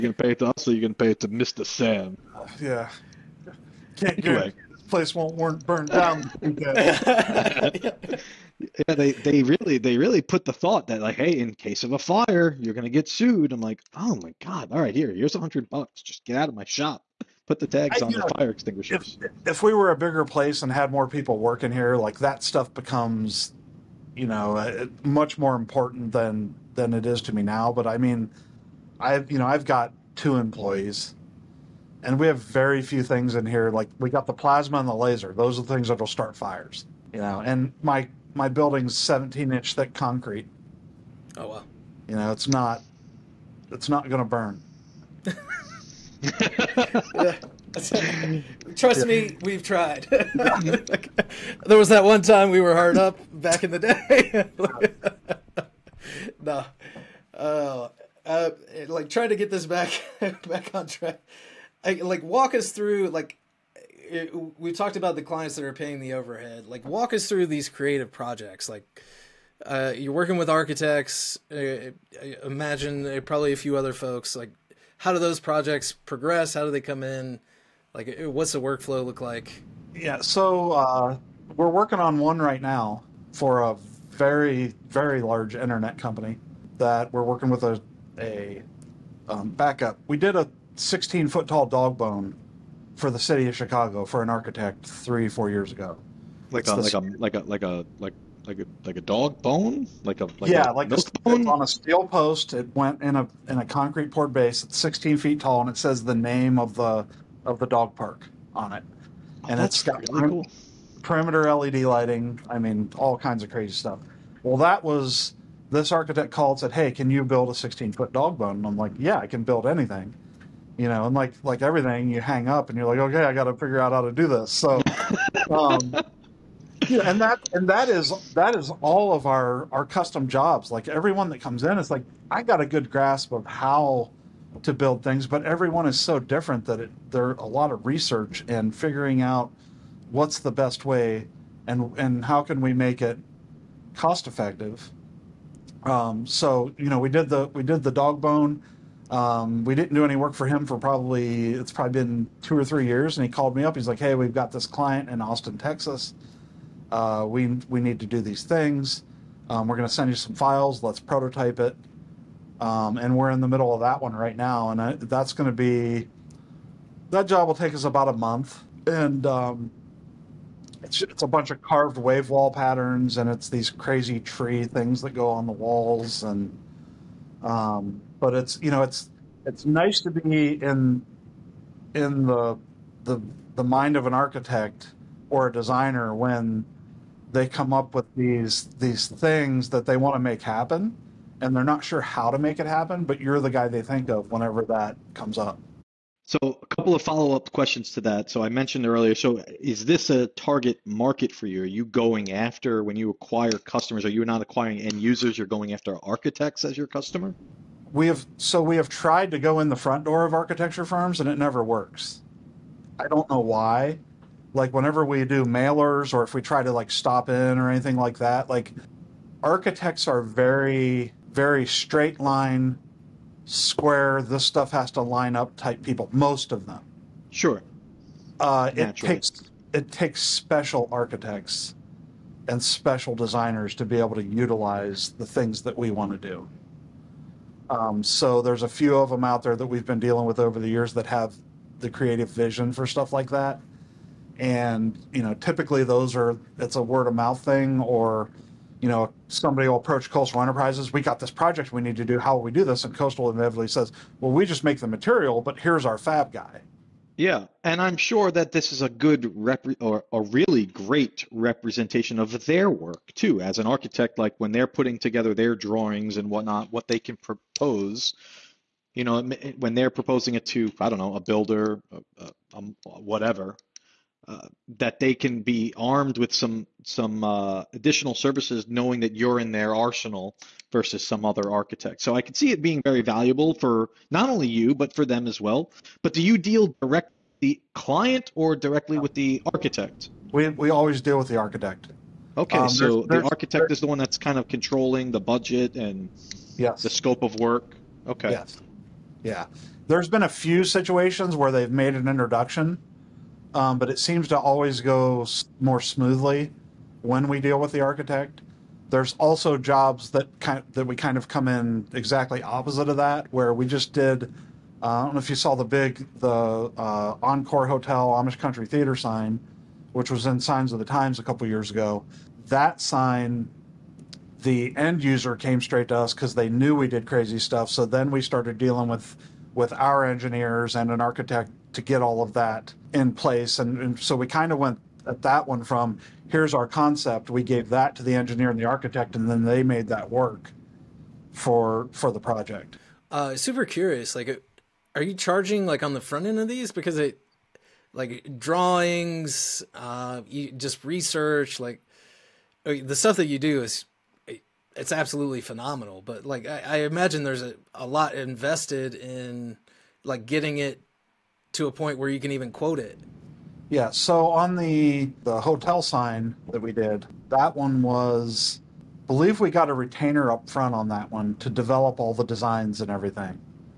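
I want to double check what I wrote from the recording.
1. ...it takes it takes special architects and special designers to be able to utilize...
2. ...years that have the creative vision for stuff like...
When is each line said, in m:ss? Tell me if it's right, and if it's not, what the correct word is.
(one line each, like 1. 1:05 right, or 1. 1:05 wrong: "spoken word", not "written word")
1. 3:48 right
2. 4:00 right.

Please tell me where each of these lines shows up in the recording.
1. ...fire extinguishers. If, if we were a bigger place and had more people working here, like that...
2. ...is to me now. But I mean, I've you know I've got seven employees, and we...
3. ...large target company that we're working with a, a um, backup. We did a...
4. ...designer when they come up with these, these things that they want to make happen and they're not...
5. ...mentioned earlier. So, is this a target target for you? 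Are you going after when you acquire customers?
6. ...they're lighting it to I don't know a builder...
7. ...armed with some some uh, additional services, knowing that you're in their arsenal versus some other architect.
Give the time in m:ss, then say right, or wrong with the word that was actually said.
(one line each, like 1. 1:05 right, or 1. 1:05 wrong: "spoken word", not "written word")
1. 0:18 right
2. 0:27 wrong: "two", not "seven"
3. 1:25 wrong: "internet", not "target"
4. 3:05 right
5. 3:18 wrong: "market", not "target"
6. 4:29 wrong: "proposing", not "lighting"
7. 4:35 right.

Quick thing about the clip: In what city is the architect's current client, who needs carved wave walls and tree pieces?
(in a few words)
Austin, Texas.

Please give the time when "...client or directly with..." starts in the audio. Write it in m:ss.
4:47.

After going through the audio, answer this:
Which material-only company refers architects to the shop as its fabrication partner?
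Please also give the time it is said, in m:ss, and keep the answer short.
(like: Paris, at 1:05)
Coastal Enterprises, at 4:10.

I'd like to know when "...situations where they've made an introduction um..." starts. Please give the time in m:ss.
5:00.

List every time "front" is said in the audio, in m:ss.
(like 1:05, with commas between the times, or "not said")
3:29, 5:46, 6:10.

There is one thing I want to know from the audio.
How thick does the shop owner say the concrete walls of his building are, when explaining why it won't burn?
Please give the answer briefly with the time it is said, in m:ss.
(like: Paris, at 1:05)
17 inch, at 0:38.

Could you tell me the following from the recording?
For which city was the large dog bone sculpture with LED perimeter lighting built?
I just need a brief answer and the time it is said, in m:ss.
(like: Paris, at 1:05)
Chicago, at 1:33.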